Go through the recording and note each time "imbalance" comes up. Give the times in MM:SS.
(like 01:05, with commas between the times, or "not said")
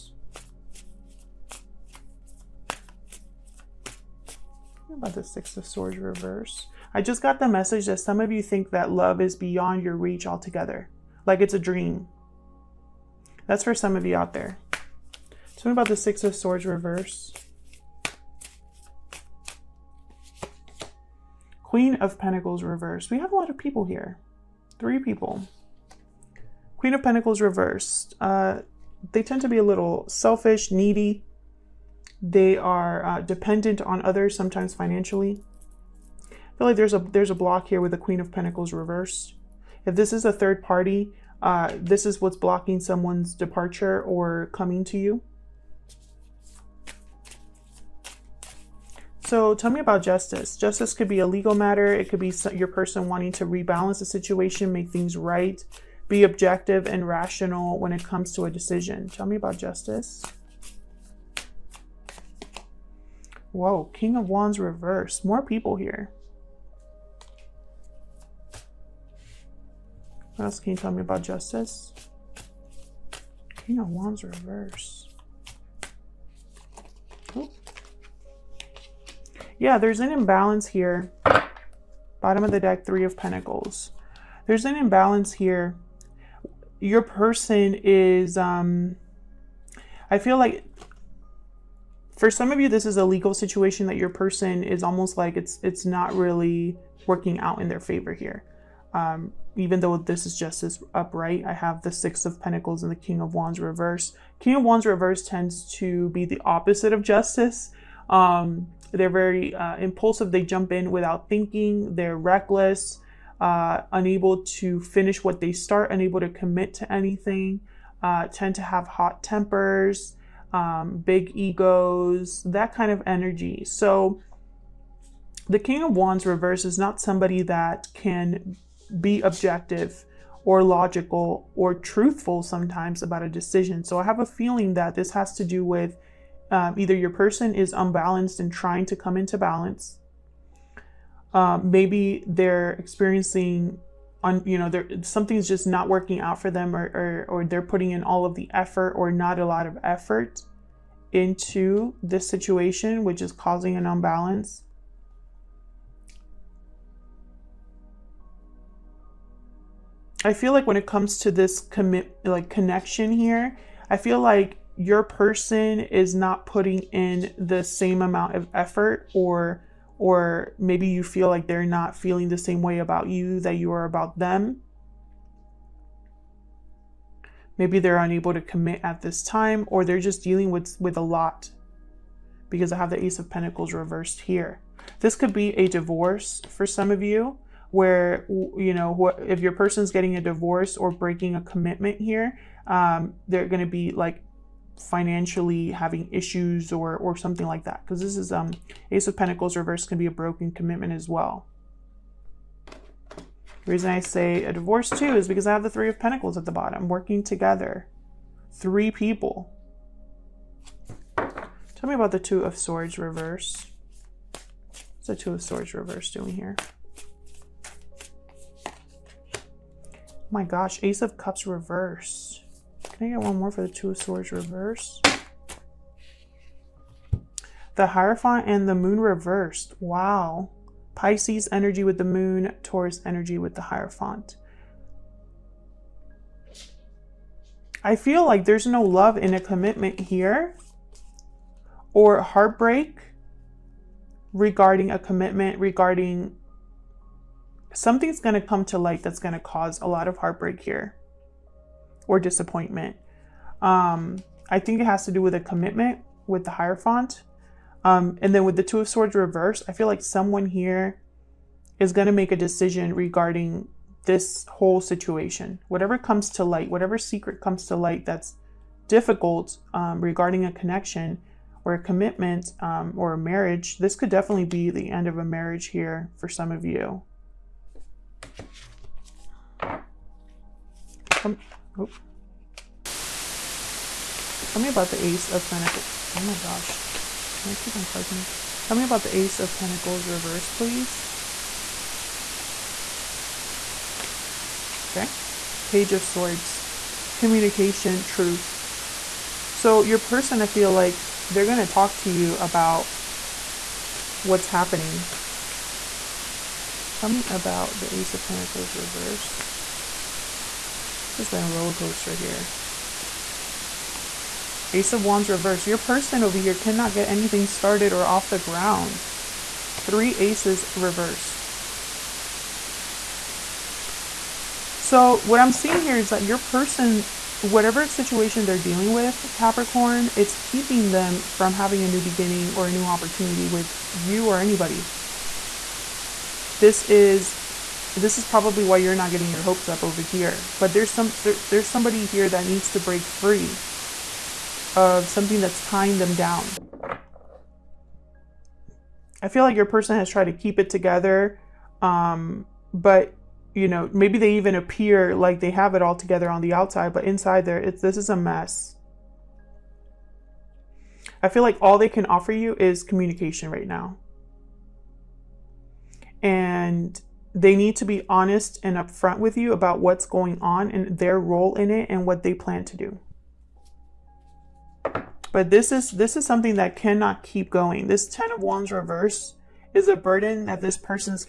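01:20, 01:24, 02:33.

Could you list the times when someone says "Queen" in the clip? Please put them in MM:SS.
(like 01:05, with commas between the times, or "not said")
00:21, 00:26, 00:37.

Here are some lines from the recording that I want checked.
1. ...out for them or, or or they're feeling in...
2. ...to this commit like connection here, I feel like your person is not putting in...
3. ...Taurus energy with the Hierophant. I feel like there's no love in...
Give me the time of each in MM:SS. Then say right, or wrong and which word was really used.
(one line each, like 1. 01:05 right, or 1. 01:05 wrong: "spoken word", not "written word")
1. 02:26 wrong: "putting", not "feeling"
2. 02:41 right
3. 03:52 right.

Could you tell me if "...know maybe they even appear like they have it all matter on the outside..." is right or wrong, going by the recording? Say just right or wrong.
wrong.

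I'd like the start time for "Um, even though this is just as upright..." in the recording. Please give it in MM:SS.
01:38.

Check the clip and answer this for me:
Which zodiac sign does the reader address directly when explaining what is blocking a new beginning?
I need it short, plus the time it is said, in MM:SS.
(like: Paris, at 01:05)
Capricorn, at 05:29.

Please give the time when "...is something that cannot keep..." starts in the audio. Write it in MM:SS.
06:16.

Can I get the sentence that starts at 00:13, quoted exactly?
That's for some of you out there.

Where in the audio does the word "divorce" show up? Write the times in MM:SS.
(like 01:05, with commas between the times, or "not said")
03:05, 03:10, 03:24.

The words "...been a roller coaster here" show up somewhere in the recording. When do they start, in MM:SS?
05:11.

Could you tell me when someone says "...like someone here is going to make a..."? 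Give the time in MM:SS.
04:19.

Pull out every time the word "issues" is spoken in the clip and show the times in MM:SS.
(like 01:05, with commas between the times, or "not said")
03:16.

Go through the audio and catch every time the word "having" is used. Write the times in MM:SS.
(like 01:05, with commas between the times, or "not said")
03:15, 05:31.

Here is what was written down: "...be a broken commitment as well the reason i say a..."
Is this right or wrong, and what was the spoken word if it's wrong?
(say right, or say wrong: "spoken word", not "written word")
right.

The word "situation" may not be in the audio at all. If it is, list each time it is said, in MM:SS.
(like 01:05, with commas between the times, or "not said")
00:54, 01:33, 02:32, 04:24, 05:27.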